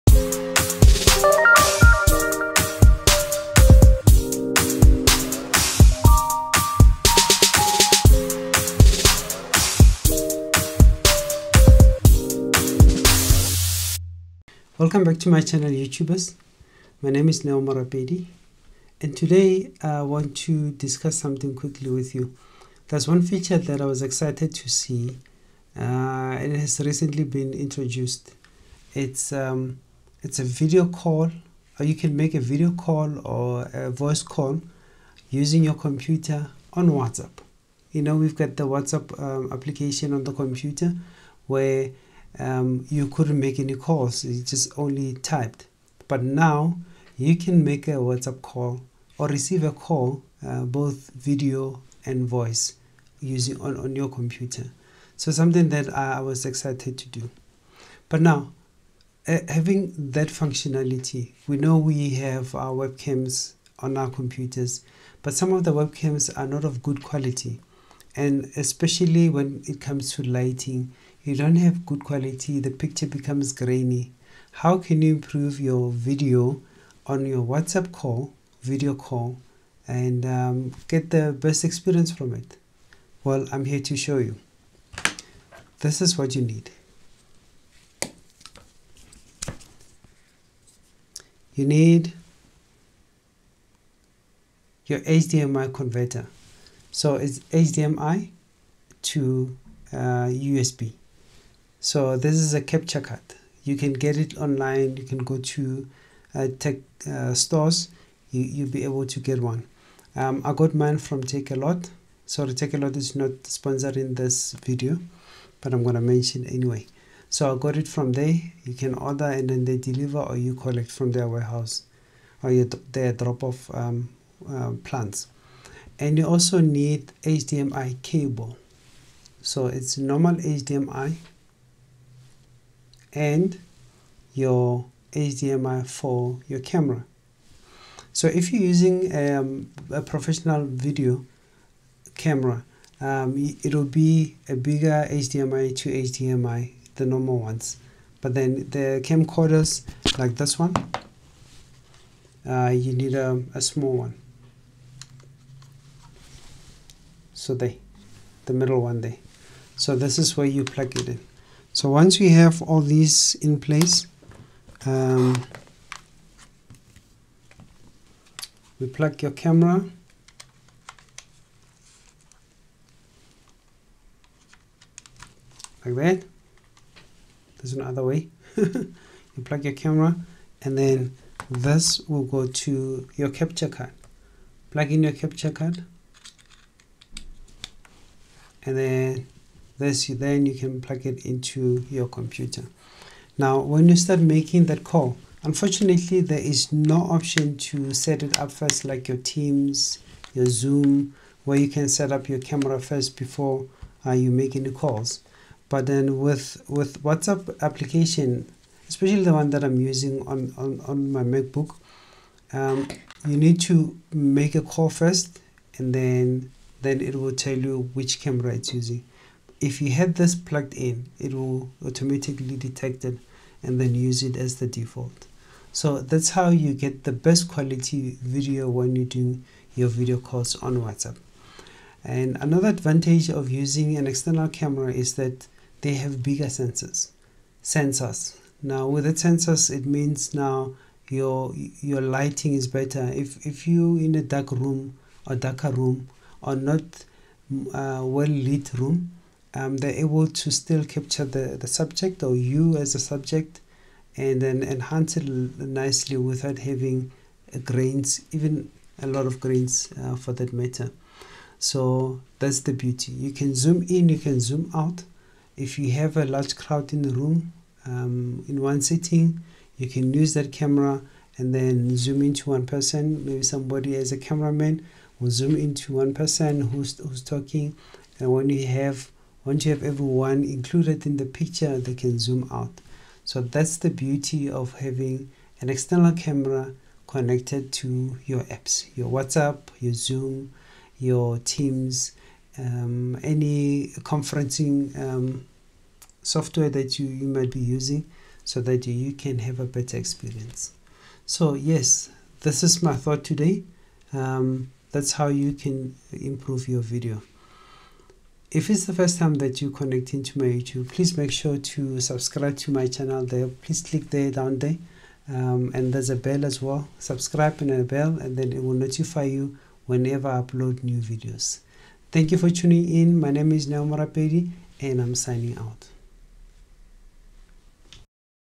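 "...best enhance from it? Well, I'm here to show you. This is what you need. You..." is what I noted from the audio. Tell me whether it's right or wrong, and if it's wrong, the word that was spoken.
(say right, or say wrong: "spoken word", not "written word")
wrong: "experience", not "enhance".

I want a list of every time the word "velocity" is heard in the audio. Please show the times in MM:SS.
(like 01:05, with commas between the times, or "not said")
not said.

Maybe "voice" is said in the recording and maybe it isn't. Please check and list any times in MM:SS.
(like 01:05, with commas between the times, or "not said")
00:33, 00:52.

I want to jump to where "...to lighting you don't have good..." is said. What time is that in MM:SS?
01:10.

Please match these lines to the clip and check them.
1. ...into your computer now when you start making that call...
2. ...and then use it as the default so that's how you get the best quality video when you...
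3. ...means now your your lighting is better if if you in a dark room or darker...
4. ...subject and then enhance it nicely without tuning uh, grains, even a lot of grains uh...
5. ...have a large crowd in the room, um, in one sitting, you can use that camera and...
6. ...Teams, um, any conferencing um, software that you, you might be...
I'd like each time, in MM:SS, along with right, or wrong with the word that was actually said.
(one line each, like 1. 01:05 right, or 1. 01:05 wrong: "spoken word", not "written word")
1. 03:11 right
2. 03:43 right
3. 03:59 right
4. 04:12 wrong: "having", not "tuning"
5. 04:25 right
6. 04:51 right.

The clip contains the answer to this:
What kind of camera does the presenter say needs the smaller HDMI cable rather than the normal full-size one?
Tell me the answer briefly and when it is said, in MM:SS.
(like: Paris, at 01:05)
camcorders, at 02:29.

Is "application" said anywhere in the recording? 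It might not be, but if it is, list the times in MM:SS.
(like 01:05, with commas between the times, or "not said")
00:39, 03:27.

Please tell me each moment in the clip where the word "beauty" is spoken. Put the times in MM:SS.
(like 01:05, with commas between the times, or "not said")
04:22, 04:43.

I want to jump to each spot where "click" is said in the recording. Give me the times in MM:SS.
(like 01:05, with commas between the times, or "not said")
05:13.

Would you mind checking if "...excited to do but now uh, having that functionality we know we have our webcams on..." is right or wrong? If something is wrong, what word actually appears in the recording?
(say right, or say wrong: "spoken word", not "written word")
right.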